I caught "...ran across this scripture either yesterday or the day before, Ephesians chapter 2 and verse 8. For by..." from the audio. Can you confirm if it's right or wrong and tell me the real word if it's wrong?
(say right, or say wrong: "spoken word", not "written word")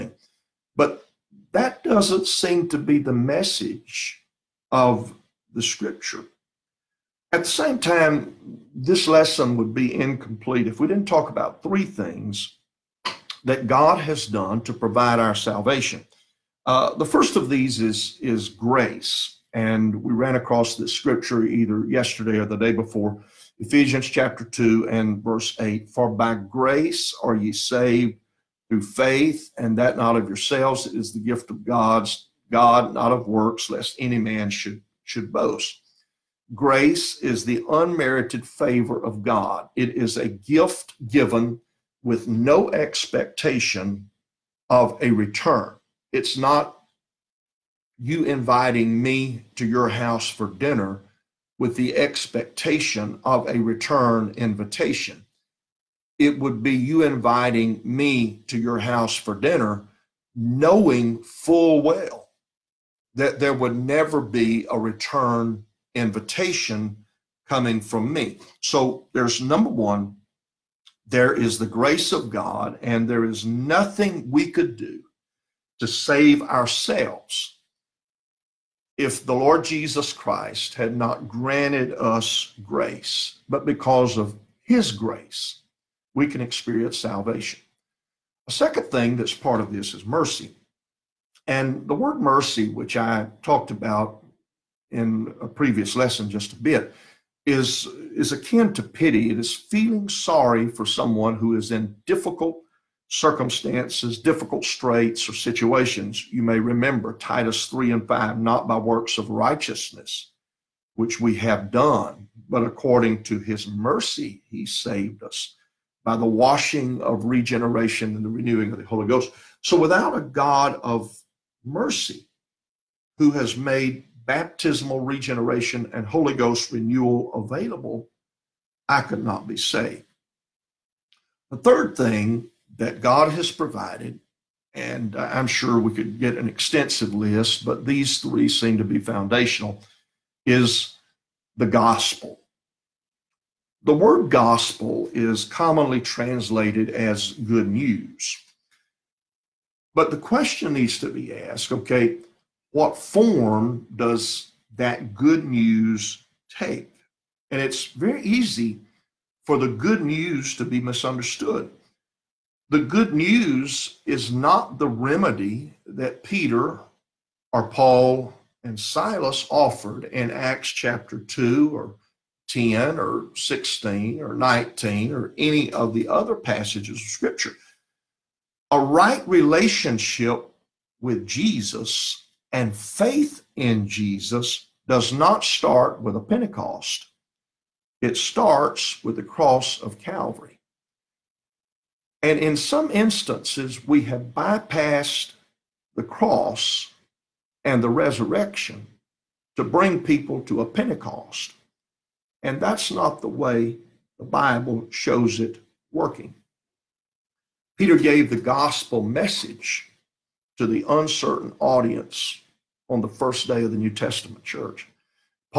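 right.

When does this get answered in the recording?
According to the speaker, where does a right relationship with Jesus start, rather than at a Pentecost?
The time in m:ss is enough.
3:09.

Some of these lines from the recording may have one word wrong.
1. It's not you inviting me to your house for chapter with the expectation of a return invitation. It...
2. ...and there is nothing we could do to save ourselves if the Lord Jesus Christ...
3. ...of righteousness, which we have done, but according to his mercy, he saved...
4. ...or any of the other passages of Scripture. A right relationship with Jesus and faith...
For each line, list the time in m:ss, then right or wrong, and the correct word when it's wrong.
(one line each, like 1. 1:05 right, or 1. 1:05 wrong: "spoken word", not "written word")
1. 0:46 wrong: "dinner", not "chapter"
2. 1:12 right
3. 1:49 right
4. 2:55 right.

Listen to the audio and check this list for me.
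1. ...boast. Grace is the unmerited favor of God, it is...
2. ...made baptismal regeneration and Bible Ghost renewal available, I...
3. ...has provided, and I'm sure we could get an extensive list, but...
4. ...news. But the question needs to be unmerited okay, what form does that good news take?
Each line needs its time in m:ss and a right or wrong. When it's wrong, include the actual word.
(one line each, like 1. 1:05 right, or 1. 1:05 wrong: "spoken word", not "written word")
1. 0:35 right
2. 2:03 wrong: "Holy", not "Bible"
3. 2:13 right
4. 2:27 wrong: "asked", not "unmerited".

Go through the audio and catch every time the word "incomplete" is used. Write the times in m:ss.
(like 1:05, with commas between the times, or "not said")
0:09.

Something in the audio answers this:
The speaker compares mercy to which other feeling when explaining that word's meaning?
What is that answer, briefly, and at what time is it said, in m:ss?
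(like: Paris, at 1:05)
Pity, at 1:38.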